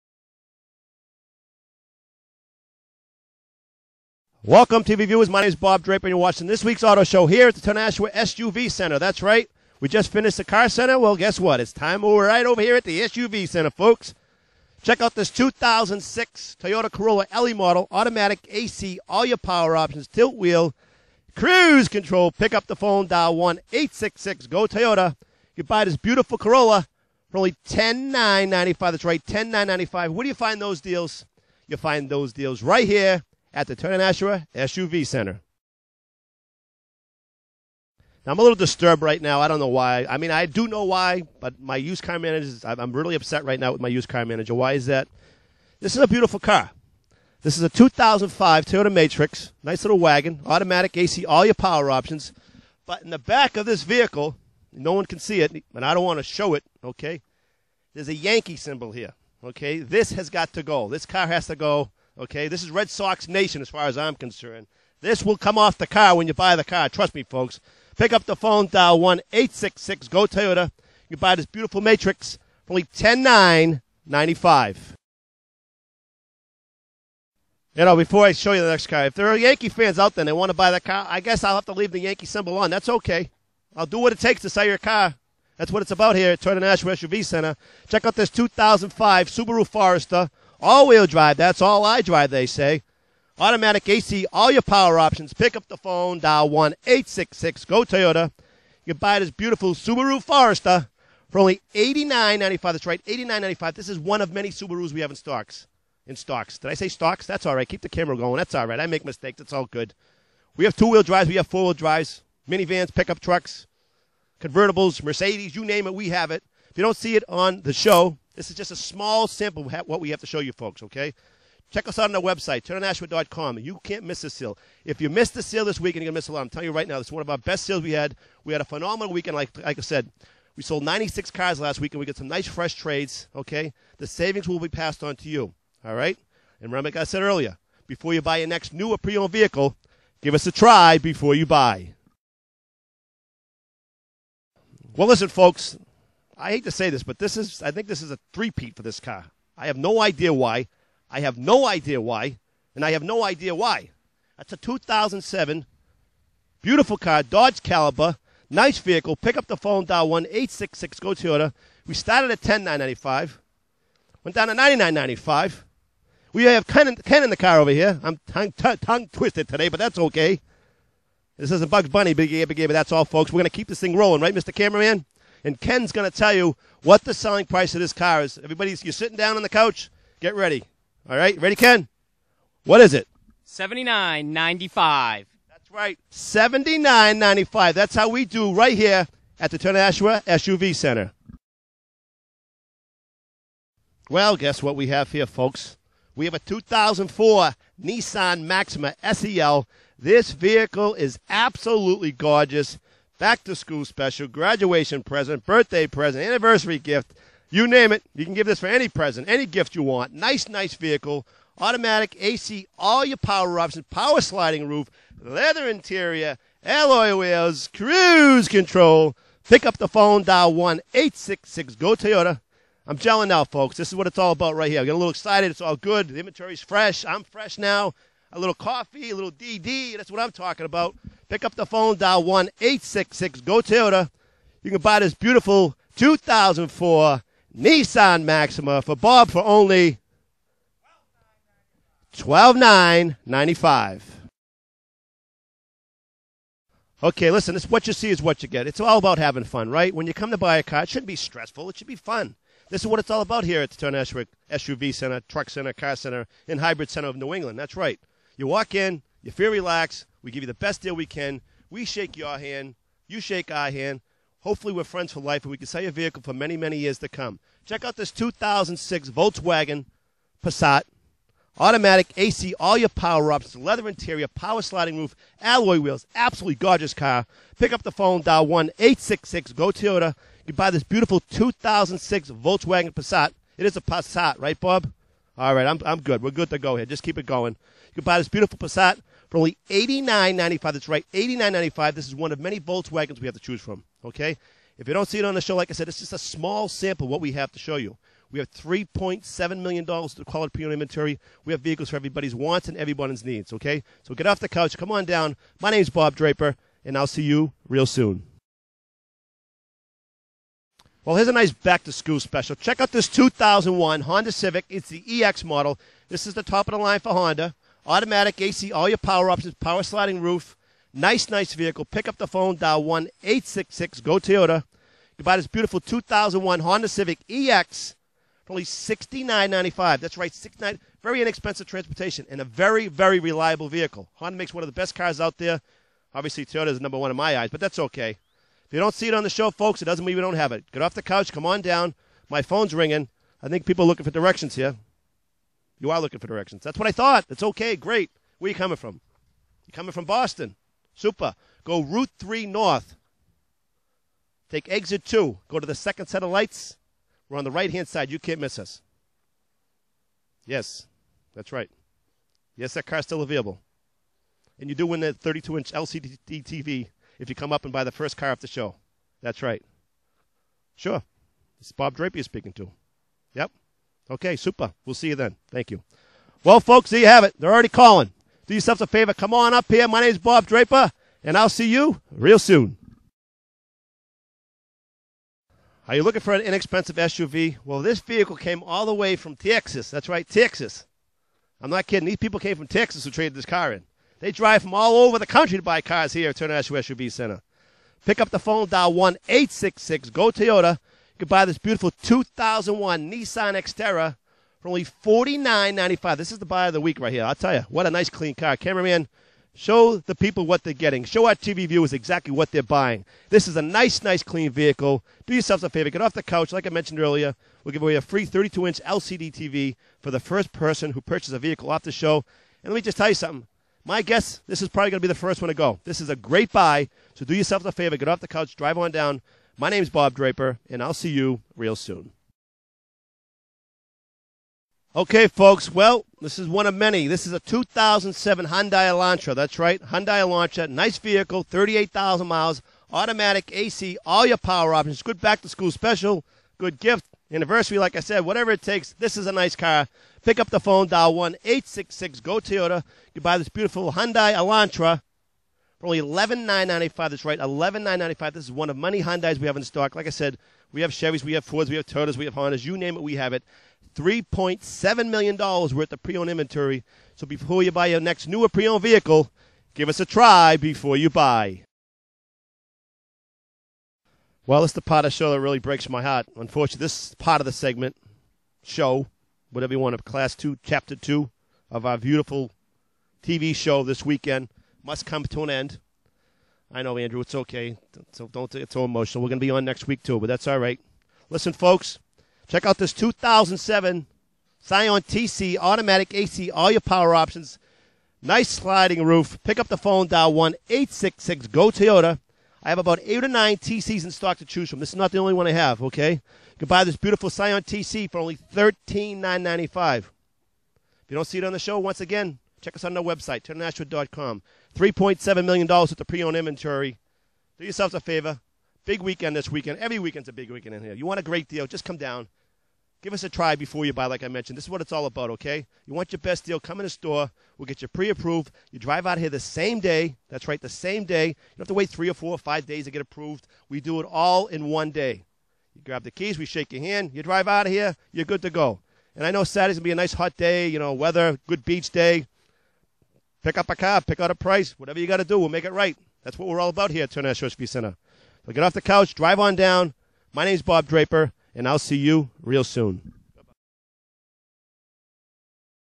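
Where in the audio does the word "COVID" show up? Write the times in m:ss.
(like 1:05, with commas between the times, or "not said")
not said.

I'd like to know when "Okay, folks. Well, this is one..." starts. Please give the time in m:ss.
7:14.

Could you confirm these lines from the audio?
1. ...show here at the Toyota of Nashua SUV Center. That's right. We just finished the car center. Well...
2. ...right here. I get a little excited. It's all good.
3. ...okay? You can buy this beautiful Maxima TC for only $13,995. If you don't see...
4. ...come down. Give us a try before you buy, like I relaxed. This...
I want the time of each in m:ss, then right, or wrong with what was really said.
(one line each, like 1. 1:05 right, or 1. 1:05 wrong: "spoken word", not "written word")
1. 0:07 right
2. 3:44 right
3. 8:25 wrong: "Scion", not "Maxima"
4. 8:41 wrong: "mentioned", not "relaxed".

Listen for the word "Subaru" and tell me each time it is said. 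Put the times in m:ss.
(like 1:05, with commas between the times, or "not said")
1:29, 1:39, 1:44.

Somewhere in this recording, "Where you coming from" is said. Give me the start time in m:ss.
5:48.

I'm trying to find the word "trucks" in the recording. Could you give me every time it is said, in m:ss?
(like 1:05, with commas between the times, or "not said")
1:53, 4:15.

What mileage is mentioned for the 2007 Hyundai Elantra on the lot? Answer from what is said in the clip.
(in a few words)
38,000.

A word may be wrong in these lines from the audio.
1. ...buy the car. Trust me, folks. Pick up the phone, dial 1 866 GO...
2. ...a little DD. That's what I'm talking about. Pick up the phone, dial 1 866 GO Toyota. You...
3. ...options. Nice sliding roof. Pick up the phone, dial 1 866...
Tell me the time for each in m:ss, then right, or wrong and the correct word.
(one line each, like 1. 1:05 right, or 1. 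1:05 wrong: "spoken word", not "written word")
1. 1:06 right
2. 3:49 right
3. 8:17 right.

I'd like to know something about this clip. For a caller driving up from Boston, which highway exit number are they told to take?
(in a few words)
Exit 2.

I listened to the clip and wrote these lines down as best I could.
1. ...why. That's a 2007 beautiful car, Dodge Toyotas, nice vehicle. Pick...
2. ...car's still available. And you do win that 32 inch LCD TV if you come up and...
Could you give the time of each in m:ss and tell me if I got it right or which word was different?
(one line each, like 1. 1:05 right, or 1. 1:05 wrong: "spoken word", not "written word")
1. 2:33 wrong: "Caliber", not "Toyotas"
2. 6:02 right.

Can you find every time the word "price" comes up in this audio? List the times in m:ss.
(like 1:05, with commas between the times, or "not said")
2:57, 9:04.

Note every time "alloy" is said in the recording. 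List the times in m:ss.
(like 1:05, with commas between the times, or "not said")
3:36, 4:35.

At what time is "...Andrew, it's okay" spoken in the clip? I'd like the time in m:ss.
8:06.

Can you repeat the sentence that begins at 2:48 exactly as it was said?
I'm tongue, t- tongue twisted today, but that's okay.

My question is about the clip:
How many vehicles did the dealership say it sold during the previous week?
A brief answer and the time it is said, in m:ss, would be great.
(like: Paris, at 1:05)
96, at 2:10.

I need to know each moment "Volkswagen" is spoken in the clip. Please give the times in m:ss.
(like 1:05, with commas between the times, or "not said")
4:29, 4:42, 4:52.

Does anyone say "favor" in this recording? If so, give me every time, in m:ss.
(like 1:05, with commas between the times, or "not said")
6:18, 6:55, 7:07, 8:37.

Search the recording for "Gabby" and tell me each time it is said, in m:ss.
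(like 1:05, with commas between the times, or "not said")
2:52.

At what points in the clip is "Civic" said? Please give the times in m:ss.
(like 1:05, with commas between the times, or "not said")
5:14, 5:26.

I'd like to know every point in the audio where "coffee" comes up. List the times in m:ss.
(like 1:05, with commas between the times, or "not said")
3:48.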